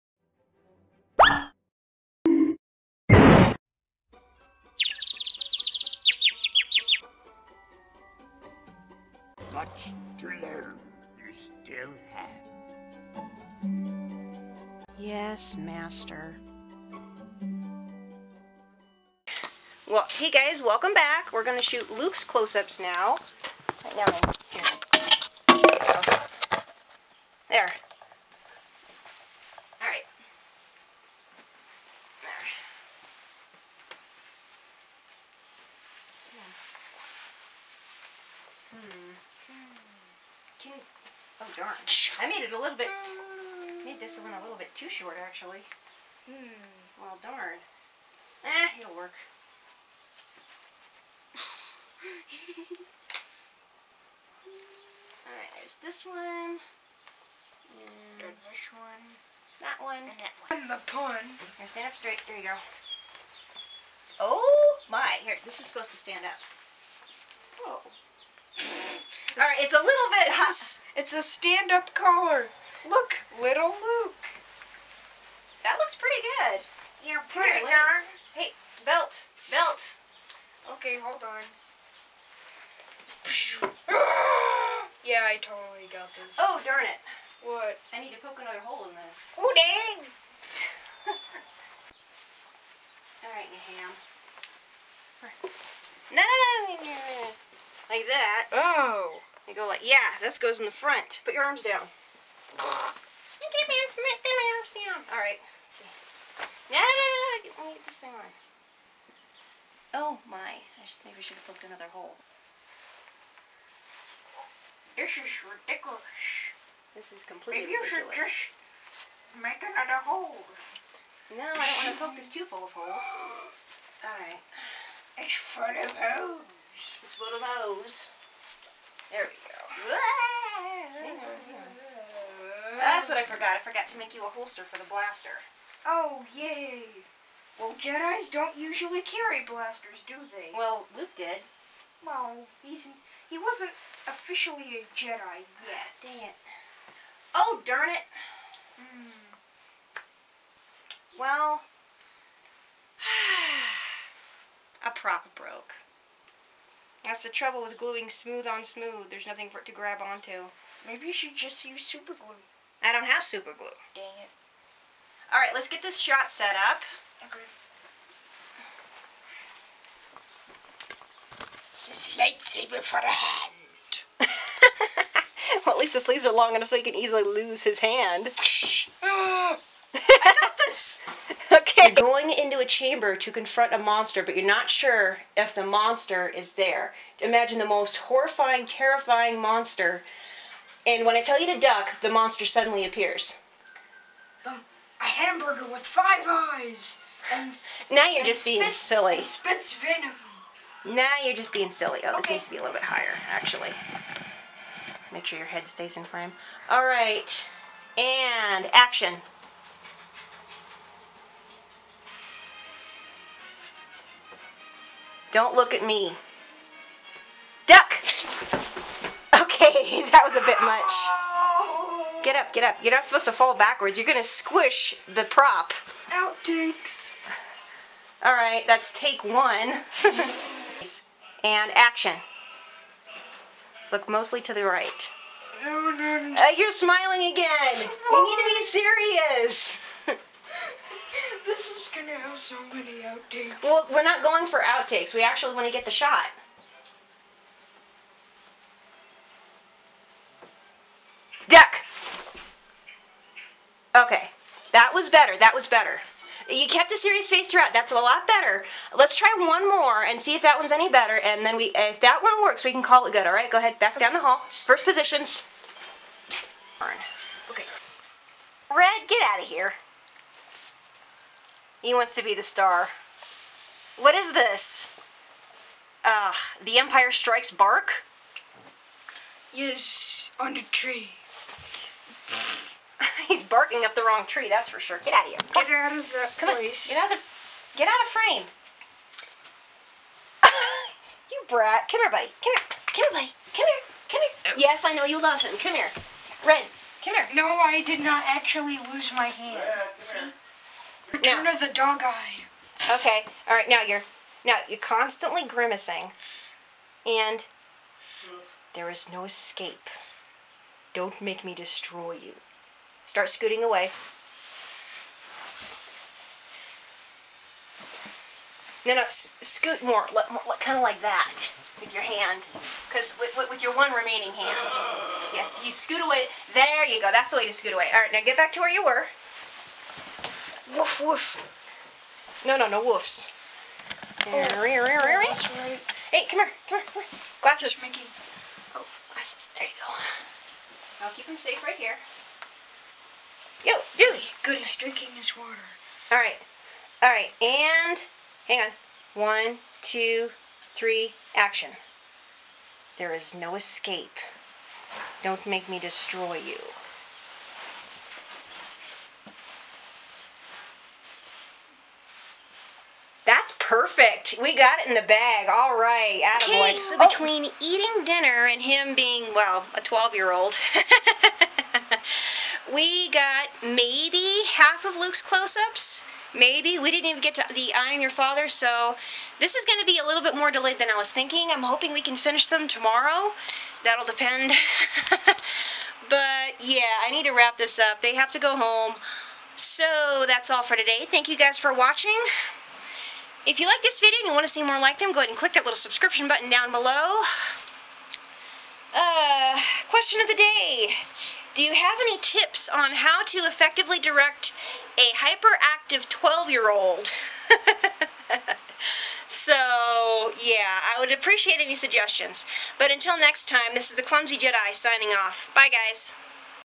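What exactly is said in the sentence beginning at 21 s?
We're going to shoot Luke's close-ups now.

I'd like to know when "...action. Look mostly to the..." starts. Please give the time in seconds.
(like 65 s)
231 s.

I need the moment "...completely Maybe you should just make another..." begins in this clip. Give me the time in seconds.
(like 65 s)
117 s.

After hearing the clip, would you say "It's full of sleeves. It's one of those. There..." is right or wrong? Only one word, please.
wrong.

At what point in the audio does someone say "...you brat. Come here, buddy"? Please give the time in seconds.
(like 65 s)
291 s.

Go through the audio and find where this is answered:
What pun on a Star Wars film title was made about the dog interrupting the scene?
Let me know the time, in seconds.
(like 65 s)
276 s.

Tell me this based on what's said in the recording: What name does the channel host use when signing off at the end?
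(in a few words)
The Clumsy Jedi.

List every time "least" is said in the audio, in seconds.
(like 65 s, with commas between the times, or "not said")
175 s.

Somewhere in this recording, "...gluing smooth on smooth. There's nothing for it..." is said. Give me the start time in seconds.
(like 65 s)
157 s.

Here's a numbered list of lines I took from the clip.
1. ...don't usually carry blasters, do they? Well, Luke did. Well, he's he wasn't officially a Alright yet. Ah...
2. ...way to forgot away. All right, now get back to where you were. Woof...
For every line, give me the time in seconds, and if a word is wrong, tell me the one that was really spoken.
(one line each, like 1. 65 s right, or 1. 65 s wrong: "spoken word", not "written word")
1. 138 s wrong: "Jedi", not "Alright"
2. 327 s wrong: "scoot", not "forgot".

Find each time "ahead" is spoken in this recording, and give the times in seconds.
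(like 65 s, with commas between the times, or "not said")
263 s, 395 s.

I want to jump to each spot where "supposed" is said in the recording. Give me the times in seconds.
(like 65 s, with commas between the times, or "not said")
65 s, 223 s.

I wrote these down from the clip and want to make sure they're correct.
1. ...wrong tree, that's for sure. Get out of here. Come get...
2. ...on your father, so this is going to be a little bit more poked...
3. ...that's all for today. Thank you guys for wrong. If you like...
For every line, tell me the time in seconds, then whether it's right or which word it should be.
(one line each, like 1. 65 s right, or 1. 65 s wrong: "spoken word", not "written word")
1. 284 s right
2. 377 s wrong: "delayed", not "poked"
3. 390 s wrong: "watching", not "wrong".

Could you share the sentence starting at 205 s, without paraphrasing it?
Make sure your head stays in frame.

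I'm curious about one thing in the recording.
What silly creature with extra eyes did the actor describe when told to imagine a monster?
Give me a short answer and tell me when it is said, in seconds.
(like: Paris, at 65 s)
A hamburger with five eyes, at 194 s.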